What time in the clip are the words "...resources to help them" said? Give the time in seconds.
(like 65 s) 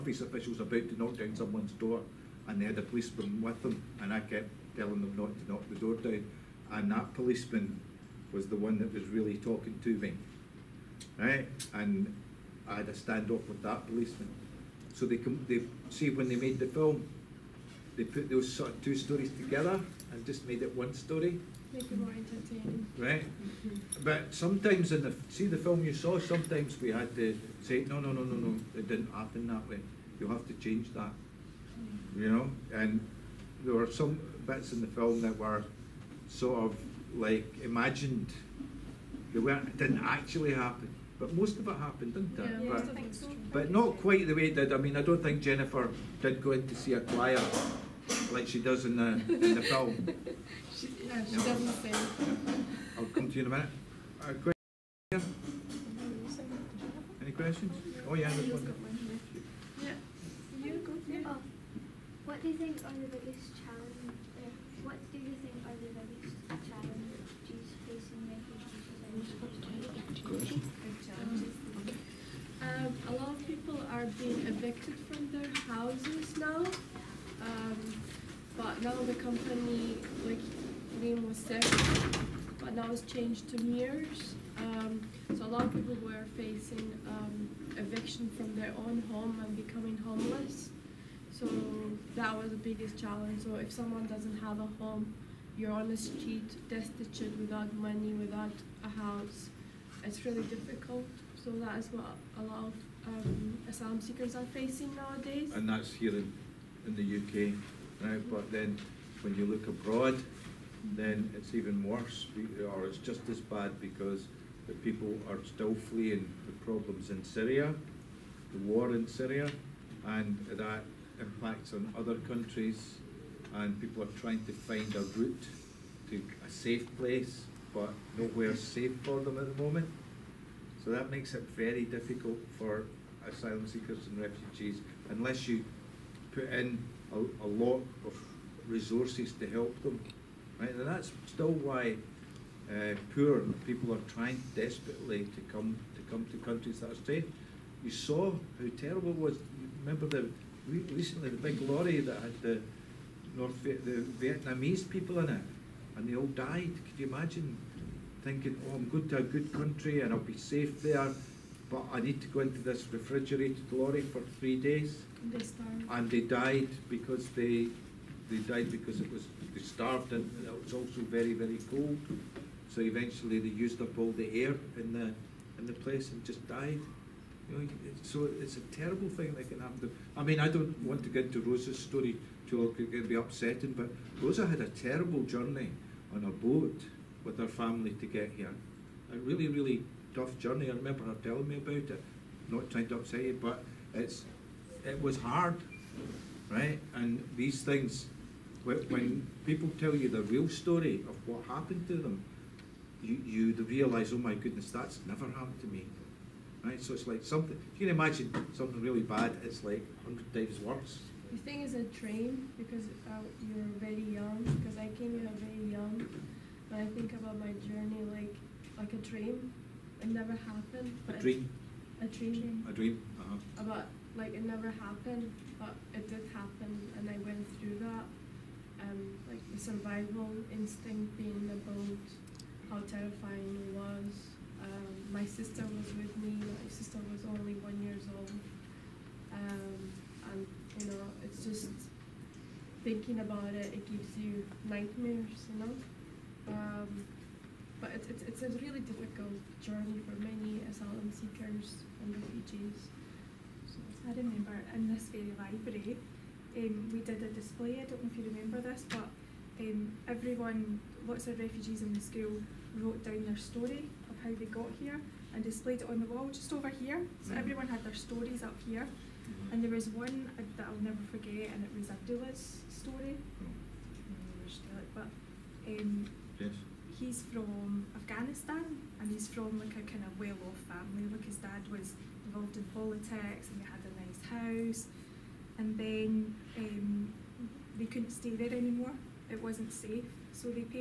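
138 s.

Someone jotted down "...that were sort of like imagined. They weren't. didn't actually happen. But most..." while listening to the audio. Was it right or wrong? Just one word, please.
right.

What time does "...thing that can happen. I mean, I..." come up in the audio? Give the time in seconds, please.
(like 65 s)
179 s.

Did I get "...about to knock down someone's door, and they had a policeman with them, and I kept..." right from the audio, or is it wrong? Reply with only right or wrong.
right.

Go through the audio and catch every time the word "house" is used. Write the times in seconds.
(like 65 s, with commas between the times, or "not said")
75 s, 98 s, 284 s.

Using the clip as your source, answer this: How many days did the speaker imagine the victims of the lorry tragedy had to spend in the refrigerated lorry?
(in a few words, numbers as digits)
3.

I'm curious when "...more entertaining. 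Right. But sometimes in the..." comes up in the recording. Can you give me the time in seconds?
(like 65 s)
21 s.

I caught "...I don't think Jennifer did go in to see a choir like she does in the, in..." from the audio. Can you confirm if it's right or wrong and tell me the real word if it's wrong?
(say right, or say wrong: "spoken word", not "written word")
right.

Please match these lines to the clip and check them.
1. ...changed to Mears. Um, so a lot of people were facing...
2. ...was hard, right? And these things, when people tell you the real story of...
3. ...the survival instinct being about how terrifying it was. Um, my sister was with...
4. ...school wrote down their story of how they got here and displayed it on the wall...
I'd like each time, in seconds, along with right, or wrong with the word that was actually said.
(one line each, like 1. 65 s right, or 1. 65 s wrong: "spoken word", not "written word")
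1. 83 s right
2. 195 s right
3. 229 s right
4. 262 s right.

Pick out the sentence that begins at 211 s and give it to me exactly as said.
The thing is a train because uh, you're very young.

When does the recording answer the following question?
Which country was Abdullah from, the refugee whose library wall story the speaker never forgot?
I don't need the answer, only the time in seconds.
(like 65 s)
277 s.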